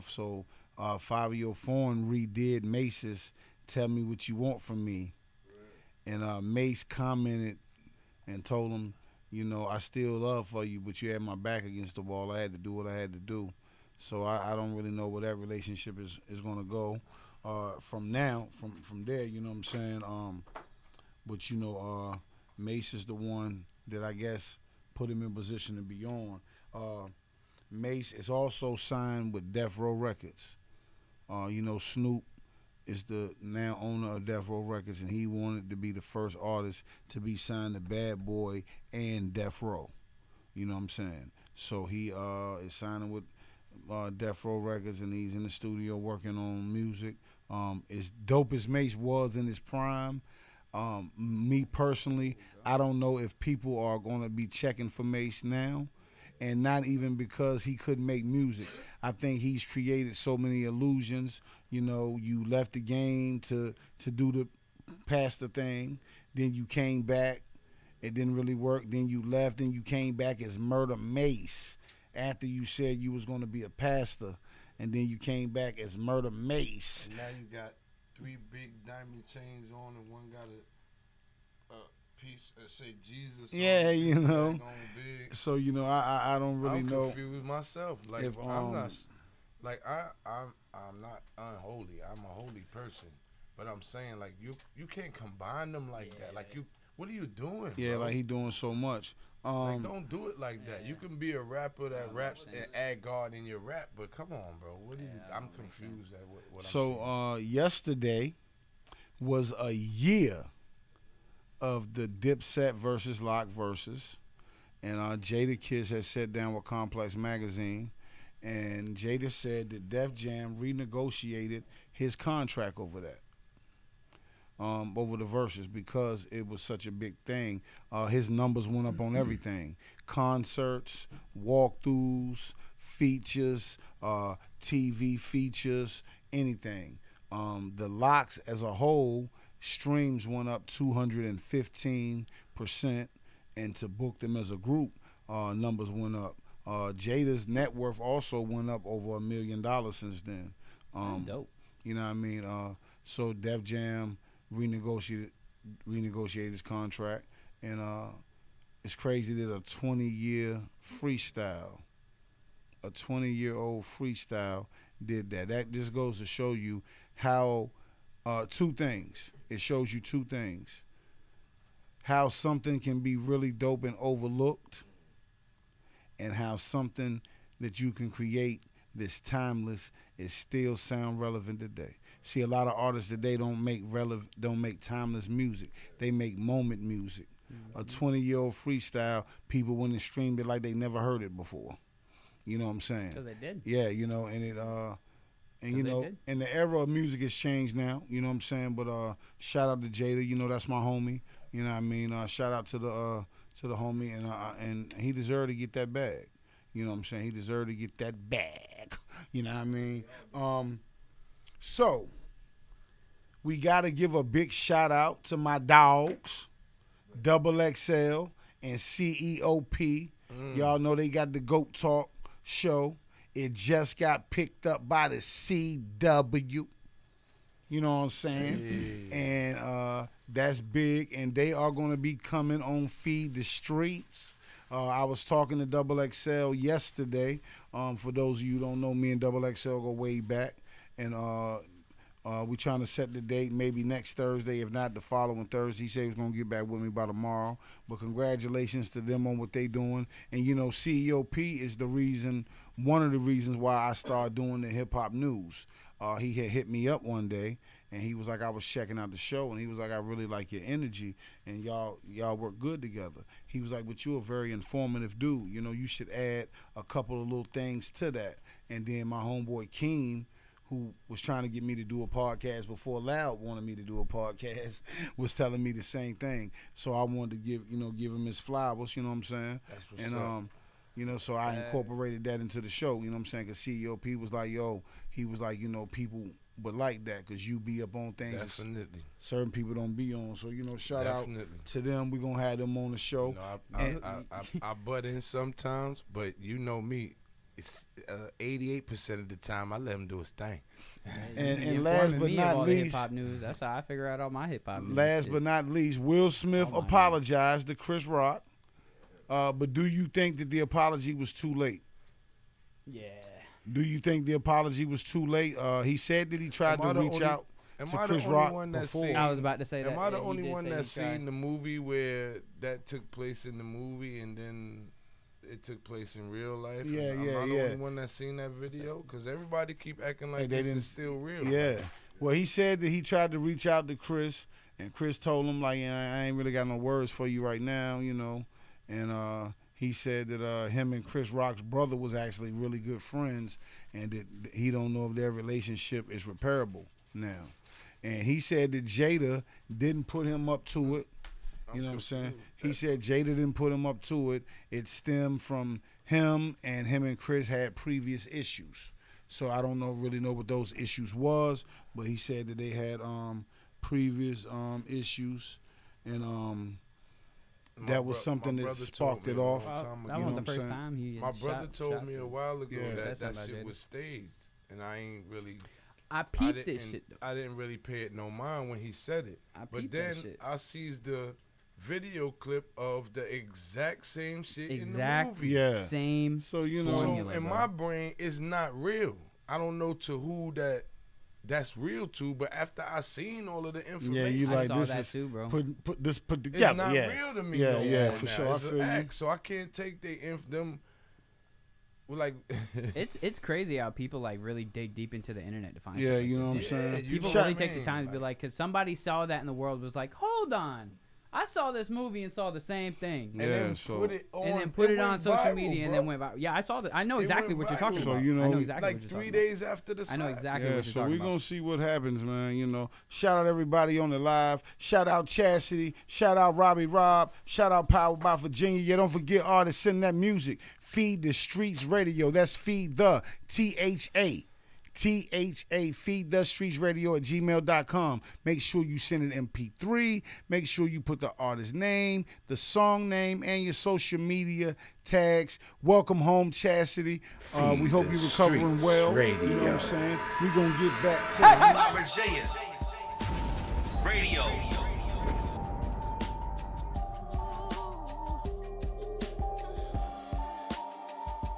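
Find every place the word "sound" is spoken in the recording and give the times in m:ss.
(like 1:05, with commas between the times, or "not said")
3:00.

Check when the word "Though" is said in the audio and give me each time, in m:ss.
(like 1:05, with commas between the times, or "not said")
6:17.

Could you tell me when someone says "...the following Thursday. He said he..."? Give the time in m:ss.
4:04.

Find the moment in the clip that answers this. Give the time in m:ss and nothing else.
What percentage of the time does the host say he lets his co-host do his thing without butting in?
4:58.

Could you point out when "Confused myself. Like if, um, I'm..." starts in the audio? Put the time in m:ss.
1:27.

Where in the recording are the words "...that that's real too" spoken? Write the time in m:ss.
6:30.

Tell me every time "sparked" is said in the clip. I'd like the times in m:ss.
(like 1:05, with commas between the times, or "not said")
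6:08.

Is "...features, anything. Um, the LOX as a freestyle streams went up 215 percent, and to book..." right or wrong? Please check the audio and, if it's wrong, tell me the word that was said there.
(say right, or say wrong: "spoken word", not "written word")
wrong: "whole", not "freestyle".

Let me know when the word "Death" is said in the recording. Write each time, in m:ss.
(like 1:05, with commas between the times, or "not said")
0:29, 0:34, 0:39, 0:44.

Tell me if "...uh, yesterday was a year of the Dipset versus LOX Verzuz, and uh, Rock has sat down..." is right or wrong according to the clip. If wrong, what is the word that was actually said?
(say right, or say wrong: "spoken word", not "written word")
wrong: "Jadakiss", not "Rock".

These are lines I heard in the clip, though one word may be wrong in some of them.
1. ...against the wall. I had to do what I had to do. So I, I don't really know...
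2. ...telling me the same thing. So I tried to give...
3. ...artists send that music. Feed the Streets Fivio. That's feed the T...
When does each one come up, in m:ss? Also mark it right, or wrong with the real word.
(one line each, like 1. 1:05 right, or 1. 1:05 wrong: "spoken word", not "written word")
1. 0:11 right
2. 4:35 wrong: "wanted", not "tried"
3. 7:09 wrong: "Radio", not "Fivio".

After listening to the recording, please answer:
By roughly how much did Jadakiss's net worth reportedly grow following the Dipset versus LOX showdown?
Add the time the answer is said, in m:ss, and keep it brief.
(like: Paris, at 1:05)
Over $1 million, at 2:29.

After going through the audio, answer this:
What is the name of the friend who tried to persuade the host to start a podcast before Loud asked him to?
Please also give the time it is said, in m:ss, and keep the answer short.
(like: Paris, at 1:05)
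Keem, at 4:29.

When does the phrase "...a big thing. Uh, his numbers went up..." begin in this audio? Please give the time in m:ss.
2:06.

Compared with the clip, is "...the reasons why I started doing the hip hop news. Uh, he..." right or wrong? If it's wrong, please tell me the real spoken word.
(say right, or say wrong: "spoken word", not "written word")
right.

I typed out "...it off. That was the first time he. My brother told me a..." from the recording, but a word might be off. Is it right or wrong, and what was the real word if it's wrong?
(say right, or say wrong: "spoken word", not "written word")
right.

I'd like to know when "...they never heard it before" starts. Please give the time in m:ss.
3:10.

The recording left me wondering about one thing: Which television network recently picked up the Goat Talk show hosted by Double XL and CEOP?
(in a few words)
CW.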